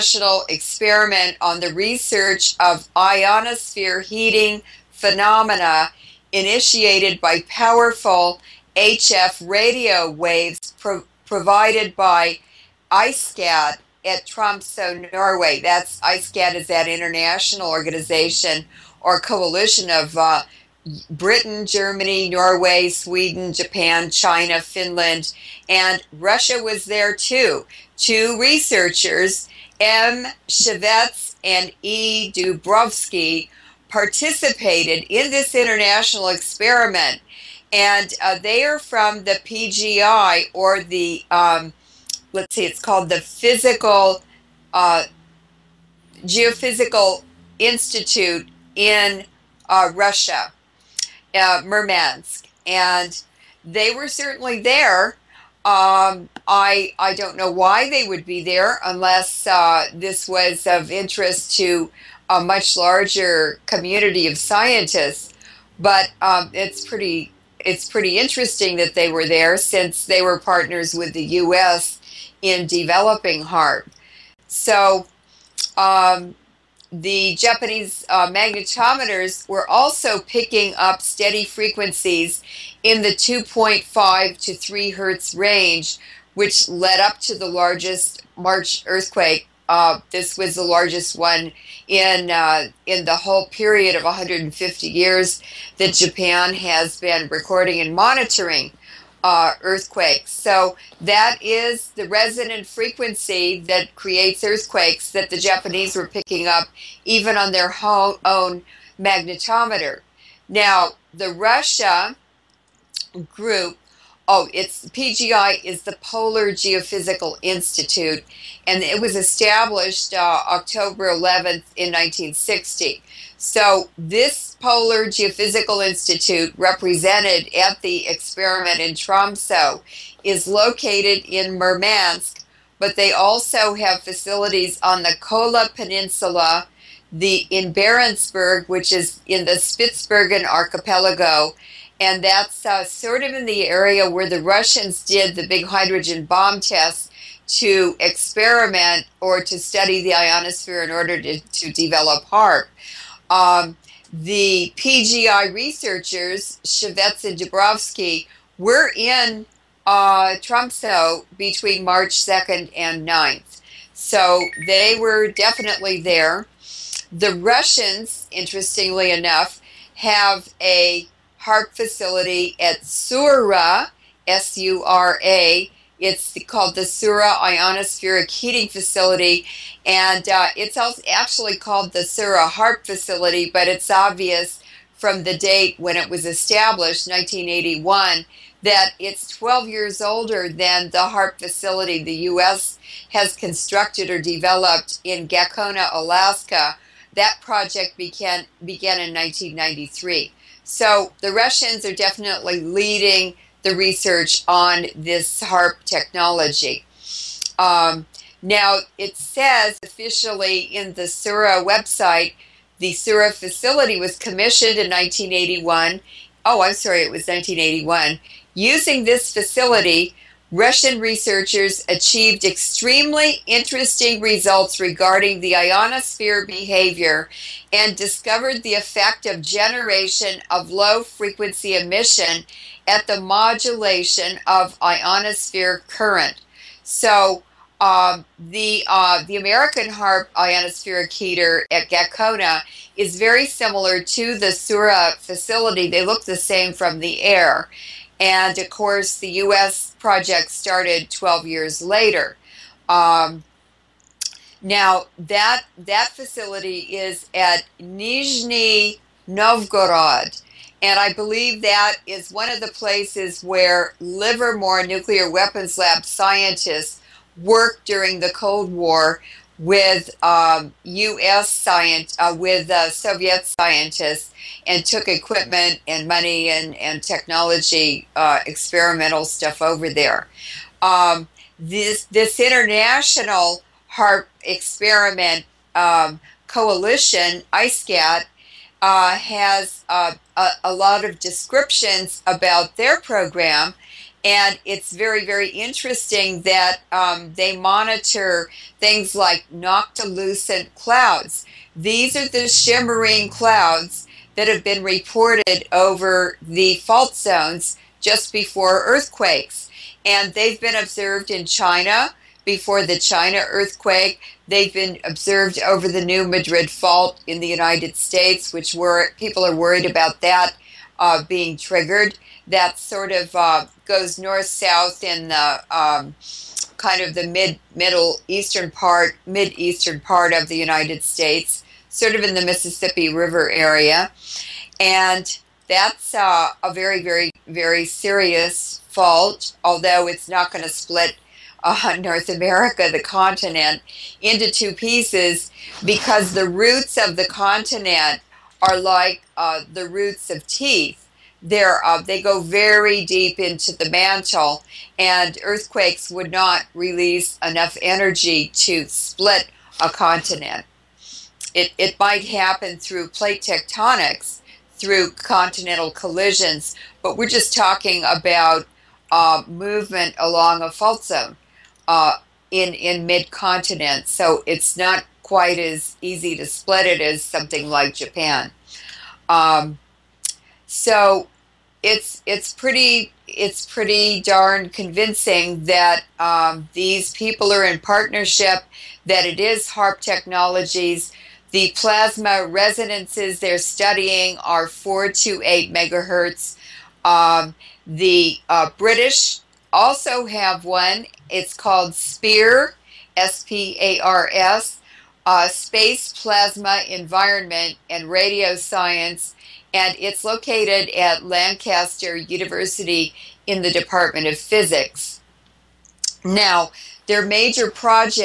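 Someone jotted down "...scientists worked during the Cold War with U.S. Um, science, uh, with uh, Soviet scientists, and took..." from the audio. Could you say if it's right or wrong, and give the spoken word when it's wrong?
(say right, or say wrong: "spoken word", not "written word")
right.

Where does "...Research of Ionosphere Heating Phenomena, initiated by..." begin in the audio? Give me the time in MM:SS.
00:01.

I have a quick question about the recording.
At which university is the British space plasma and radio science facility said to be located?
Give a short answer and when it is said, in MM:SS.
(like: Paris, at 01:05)
Lancaster University, at 06:51.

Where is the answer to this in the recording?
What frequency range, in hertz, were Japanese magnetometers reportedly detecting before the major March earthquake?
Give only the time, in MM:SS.
01:23.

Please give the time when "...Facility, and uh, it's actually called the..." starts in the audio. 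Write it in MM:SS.
02:58.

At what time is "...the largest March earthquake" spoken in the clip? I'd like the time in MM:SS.
01:27.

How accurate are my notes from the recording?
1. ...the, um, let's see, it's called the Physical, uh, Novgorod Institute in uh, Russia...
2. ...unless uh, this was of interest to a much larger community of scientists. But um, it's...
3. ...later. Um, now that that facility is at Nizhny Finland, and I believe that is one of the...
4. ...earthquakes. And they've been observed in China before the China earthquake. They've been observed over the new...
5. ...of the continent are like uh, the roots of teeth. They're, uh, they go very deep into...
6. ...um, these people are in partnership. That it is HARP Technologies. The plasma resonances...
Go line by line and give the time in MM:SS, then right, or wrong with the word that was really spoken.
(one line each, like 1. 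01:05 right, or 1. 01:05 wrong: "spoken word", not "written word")
1. 00:40 wrong: "Geophysical", not "Novgorod"
2. 00:58 right
3. 04:11 wrong: "Novgorod", not "Finland"
4. 05:08 right
5. 05:46 right
6. 06:26 right.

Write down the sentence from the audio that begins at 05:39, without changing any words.
Although it's not going to split.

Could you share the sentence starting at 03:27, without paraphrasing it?
Um, now, it says officially in the Sura website, the Sura facility was commissioned in 1981.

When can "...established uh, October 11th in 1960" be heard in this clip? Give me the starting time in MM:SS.
01:59.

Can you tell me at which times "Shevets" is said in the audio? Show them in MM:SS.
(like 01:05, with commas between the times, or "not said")
00:30, 02:36.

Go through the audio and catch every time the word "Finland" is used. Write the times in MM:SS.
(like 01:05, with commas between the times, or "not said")
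00:24.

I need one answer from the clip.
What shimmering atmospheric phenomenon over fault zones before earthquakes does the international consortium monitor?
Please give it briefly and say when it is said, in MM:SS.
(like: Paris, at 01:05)
noctilucent clouds, at 04:59.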